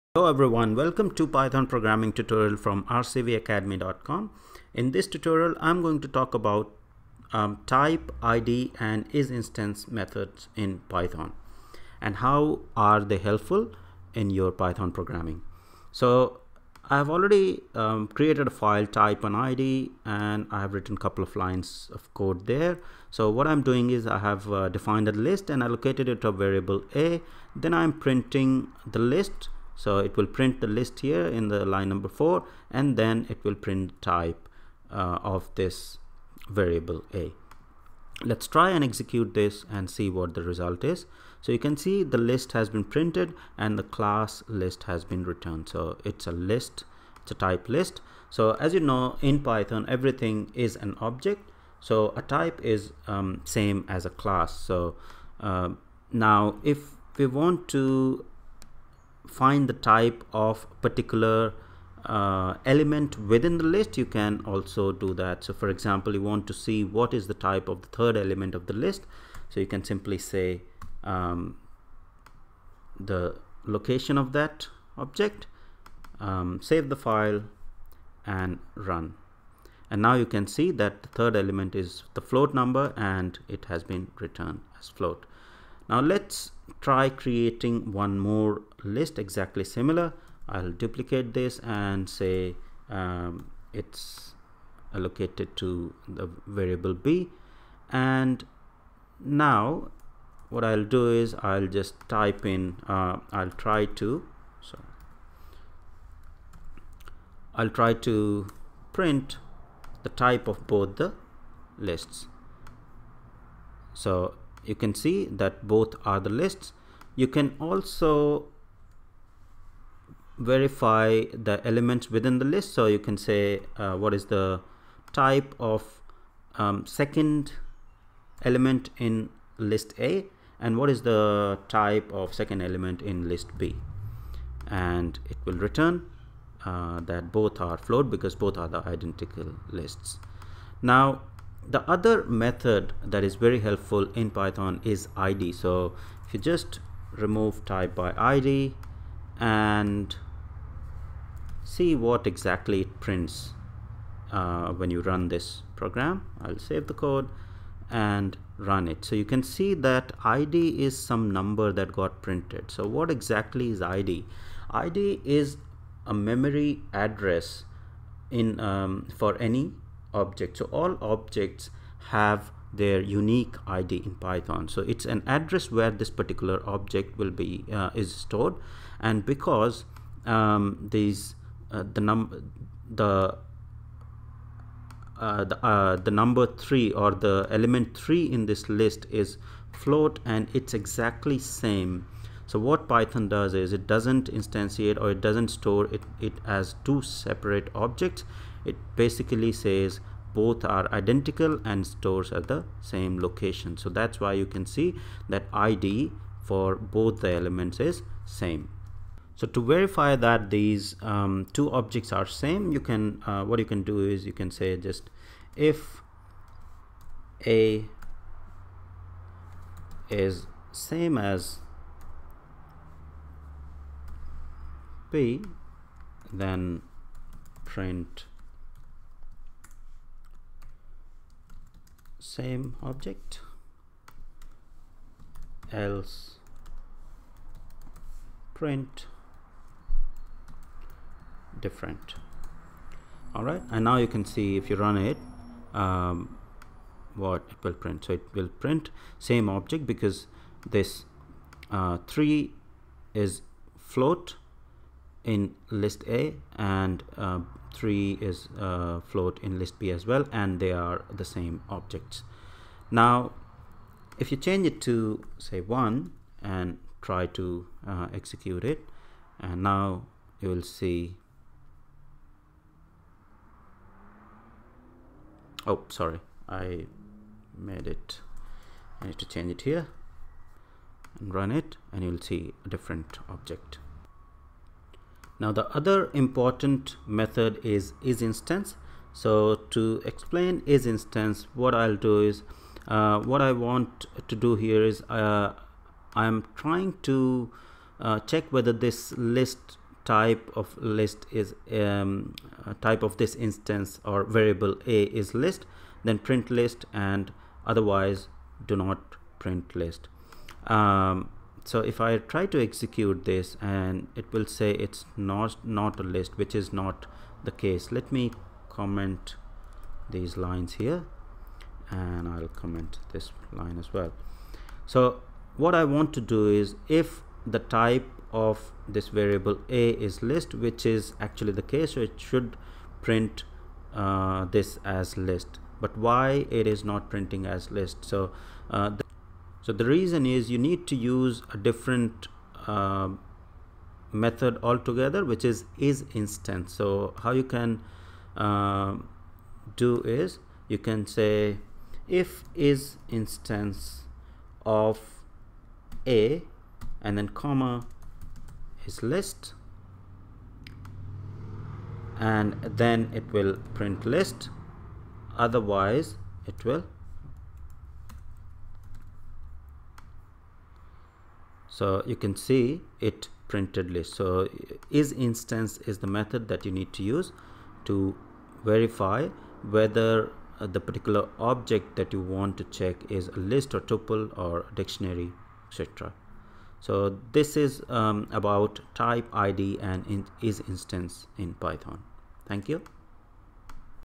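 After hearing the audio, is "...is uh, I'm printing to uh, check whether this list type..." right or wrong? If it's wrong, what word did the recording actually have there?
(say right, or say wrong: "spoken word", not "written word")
wrong: "trying", not "printing".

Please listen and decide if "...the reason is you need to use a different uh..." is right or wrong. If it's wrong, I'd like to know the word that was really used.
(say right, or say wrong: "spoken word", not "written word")
right.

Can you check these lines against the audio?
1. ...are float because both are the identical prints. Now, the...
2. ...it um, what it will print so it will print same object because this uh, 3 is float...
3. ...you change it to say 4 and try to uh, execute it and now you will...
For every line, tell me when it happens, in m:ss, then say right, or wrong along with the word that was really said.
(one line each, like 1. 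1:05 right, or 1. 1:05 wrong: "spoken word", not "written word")
1. 2:17 wrong: "lists", not "prints"
2. 4:04 right
3. 4:24 wrong: "1", not "4".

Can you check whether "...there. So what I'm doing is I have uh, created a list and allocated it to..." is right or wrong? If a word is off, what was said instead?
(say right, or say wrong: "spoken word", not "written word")
wrong: "defined", not "created".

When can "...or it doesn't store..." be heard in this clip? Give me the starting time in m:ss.
3:14.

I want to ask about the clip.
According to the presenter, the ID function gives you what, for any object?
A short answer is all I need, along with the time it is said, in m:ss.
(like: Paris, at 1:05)
a memory address, at 2:44.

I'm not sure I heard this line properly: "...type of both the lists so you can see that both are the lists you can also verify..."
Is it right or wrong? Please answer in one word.
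right.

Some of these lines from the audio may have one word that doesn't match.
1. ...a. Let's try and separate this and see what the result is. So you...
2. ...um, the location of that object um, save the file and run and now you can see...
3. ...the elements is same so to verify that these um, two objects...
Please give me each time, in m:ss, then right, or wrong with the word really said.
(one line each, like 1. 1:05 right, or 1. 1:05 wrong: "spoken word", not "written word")
1. 0:37 wrong: "execute", not "separate"
2. 1:11 right
3. 3:27 right.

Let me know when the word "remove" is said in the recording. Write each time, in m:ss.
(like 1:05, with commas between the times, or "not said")
2:27.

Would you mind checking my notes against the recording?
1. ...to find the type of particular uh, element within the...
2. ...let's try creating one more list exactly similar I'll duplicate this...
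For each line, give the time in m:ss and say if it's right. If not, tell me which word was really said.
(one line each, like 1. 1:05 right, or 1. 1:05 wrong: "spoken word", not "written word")
1. 0:57 right
2. 1:25 right.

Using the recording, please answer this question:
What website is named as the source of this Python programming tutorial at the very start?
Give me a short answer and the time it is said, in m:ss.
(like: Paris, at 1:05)
rcvacademy.com, at 0:02.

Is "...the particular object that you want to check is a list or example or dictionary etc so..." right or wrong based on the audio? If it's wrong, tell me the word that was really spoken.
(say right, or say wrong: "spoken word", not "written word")
wrong: "tuple", not "example".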